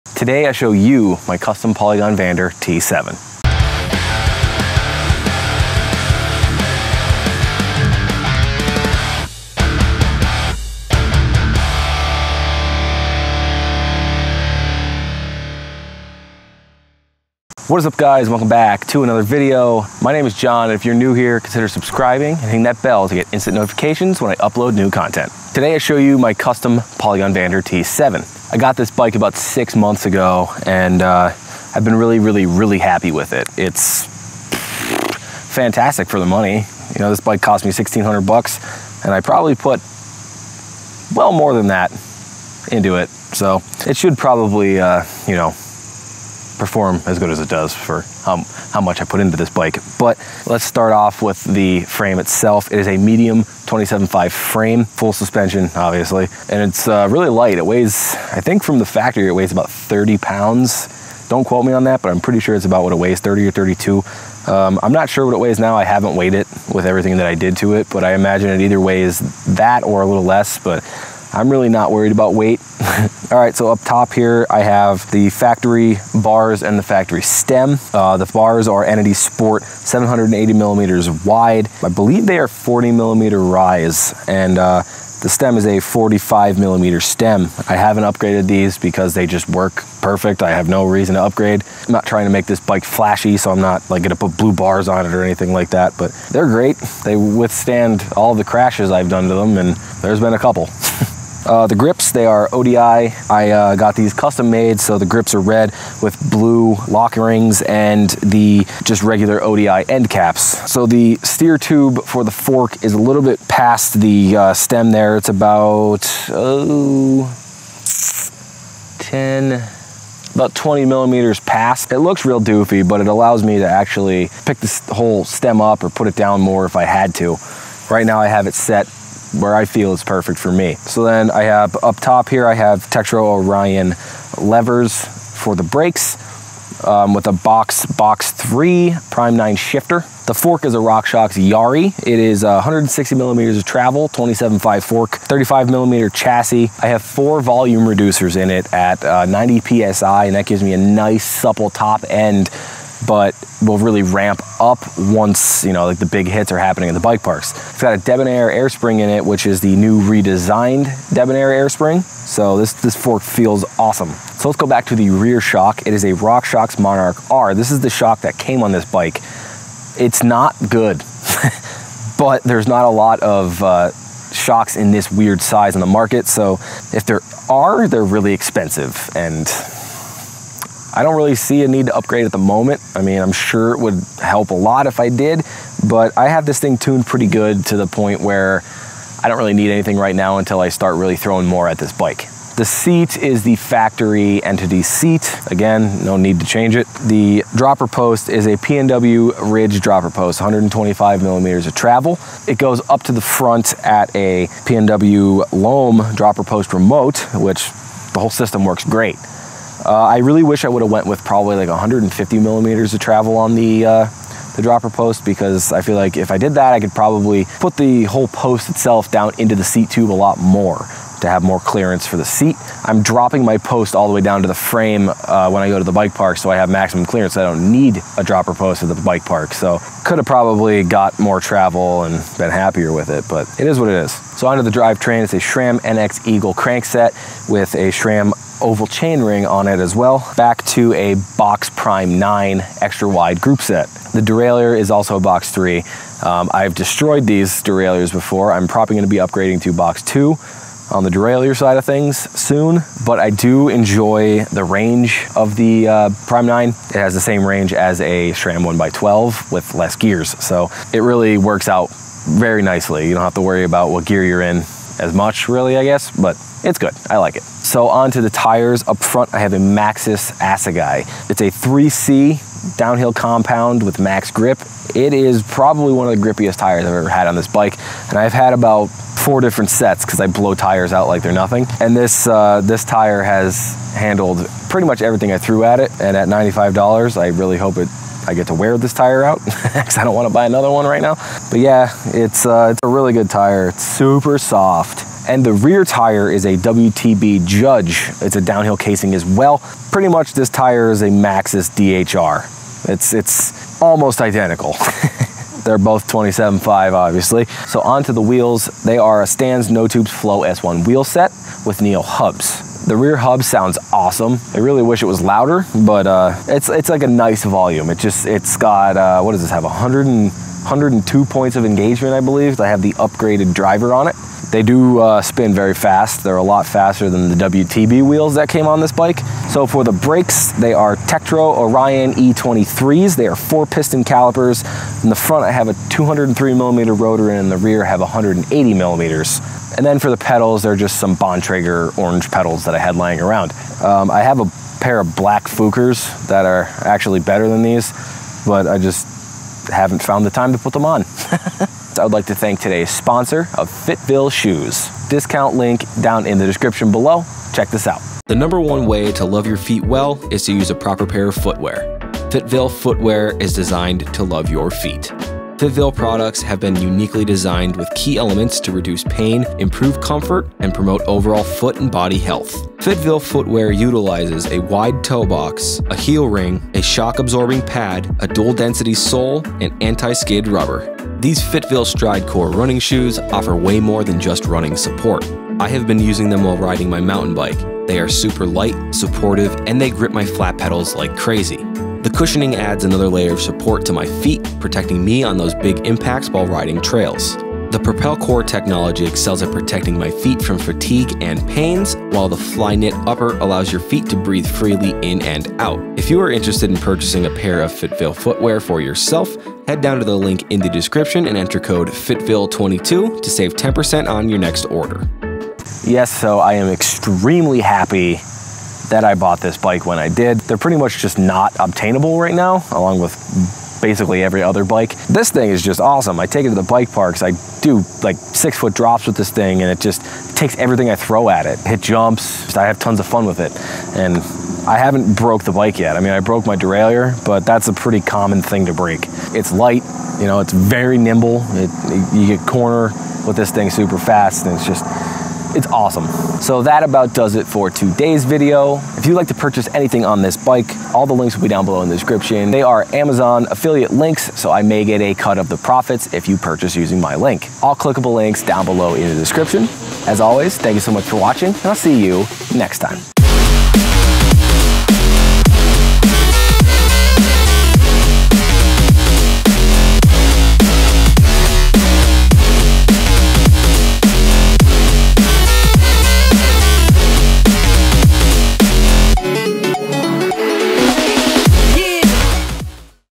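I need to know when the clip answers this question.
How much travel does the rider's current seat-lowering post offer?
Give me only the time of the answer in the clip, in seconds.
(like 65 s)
200 s.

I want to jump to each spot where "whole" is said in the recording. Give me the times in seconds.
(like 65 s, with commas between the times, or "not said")
124 s, 208 s, 218 s.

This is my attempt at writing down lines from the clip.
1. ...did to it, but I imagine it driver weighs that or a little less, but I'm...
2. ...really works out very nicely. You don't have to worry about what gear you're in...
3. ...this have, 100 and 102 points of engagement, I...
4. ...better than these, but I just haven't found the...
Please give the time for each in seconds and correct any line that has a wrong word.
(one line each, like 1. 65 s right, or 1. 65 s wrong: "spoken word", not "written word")
1. 67 s wrong: "either", not "driver"
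2. 260 s right
3. 319 s right
4. 347 s right.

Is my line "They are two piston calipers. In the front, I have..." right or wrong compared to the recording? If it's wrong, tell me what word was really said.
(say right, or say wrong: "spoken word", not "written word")
wrong: "four", not "two".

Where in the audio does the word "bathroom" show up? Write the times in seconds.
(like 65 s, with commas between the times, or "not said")
not said.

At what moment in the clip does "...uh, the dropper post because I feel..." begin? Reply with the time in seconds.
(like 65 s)
213 s.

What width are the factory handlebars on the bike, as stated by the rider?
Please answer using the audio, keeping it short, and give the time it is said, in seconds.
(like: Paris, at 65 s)
780 millimeters, at 79 s.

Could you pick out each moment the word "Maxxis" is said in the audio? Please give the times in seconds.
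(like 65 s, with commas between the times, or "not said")
269 s, 301 s.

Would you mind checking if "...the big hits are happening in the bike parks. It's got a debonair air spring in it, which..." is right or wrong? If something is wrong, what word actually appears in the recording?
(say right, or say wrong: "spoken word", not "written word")
right.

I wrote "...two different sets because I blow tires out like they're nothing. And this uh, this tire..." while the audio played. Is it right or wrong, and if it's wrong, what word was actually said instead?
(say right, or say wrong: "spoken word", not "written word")
wrong: "four", not "two".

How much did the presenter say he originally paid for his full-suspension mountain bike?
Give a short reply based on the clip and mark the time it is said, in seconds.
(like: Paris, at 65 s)
$1600, at 37 s.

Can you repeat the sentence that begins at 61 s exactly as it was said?
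Don't quote me on that, but I'm pretty sure it's about what it weighs, 30 or 32.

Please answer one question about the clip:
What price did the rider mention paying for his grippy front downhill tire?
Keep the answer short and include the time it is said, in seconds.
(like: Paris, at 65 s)
$95, at 286 s.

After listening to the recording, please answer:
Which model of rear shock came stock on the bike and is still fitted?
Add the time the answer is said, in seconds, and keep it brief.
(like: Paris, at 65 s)
RockShox Monarch R, at 166 s.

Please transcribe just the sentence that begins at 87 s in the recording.
I haven't upgraded these because they just work perfect.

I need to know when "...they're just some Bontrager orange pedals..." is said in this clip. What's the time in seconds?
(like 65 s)
340 s.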